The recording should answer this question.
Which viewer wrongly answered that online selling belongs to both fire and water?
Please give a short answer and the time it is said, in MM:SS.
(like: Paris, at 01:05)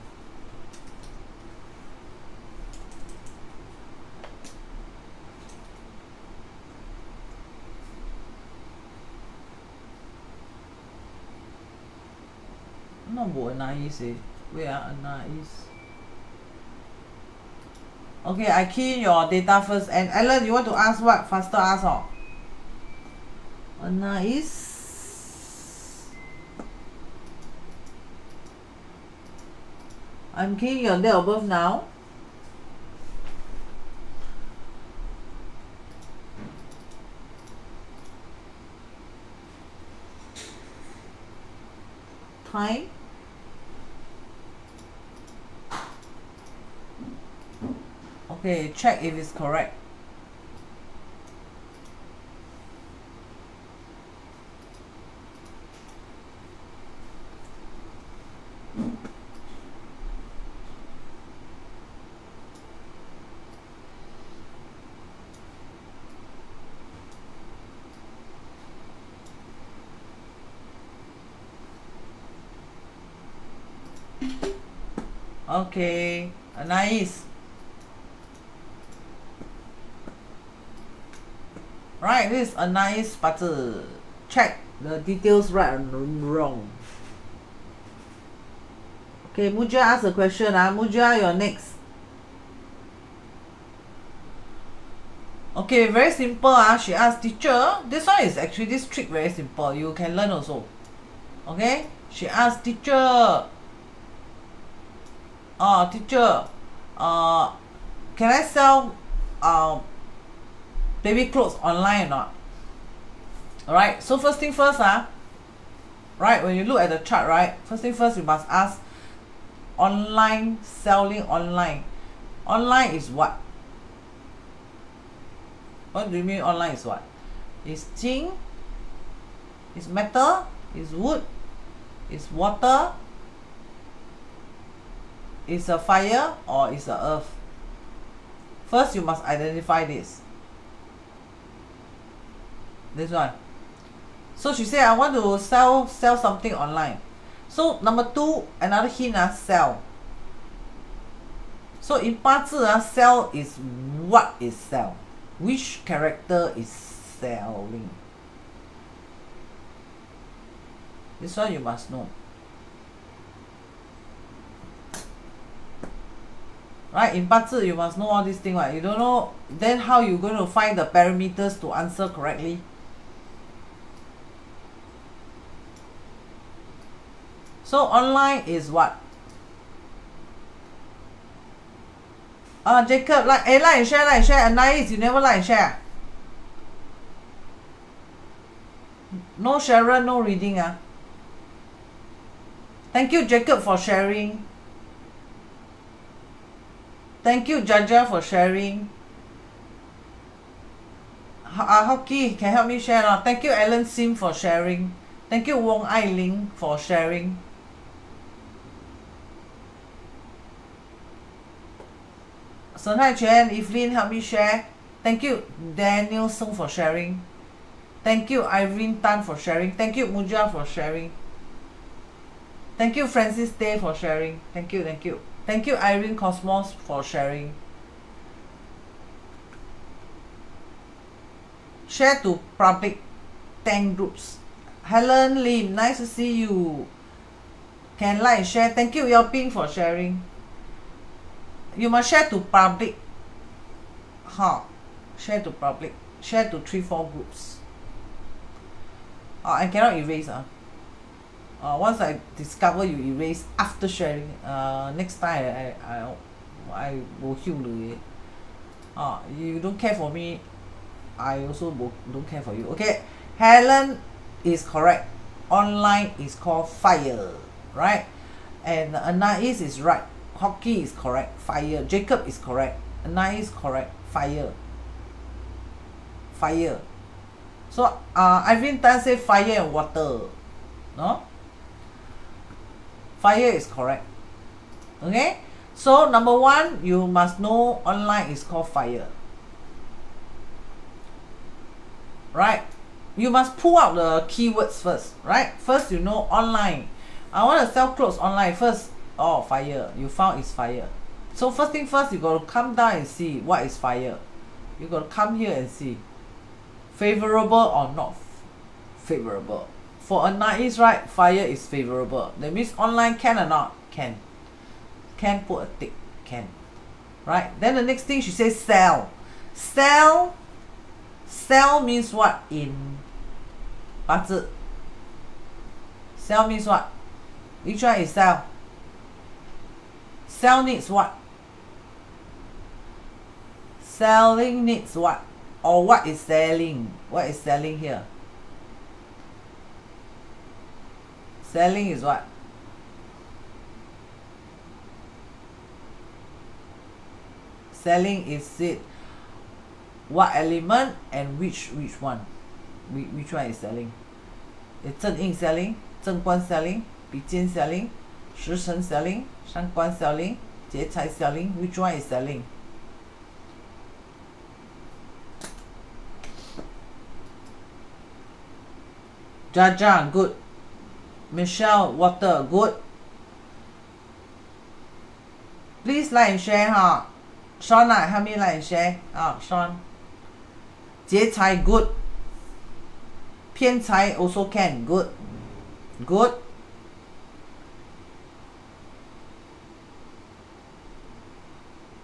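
Ivan Tan, at 04:38.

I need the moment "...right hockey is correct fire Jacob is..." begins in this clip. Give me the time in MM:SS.
04:29.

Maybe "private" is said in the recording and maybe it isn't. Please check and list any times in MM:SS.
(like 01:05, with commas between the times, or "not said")
not said.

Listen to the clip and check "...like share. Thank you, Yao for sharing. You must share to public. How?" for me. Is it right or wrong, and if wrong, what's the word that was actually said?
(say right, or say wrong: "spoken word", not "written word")
right.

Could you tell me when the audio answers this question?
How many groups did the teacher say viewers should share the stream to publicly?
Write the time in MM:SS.
03:53.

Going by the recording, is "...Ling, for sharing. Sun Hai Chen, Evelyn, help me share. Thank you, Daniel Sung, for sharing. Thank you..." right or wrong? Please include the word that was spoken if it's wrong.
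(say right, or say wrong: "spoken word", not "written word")
right.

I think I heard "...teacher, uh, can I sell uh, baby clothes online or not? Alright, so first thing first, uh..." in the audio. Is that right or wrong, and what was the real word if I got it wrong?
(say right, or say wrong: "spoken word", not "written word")
right.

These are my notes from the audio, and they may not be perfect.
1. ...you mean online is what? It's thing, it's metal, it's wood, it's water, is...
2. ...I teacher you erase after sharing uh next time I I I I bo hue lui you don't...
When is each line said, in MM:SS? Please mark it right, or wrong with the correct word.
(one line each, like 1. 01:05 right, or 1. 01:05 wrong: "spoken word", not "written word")
1. 02:06 right
2. 04:11 wrong: "discover", not "teacher".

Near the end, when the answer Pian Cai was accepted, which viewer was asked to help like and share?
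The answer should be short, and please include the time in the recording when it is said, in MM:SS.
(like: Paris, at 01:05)
Sean, at 06:17.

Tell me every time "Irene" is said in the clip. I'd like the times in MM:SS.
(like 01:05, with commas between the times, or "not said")
03:38, 03:45.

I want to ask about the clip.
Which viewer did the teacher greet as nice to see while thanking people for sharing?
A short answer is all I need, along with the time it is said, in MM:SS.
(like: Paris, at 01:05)
Helen Lim, at 03:54.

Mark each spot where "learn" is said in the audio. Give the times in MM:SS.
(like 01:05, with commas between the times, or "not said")
01:40.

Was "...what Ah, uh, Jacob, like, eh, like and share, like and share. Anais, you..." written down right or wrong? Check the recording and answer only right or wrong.
right.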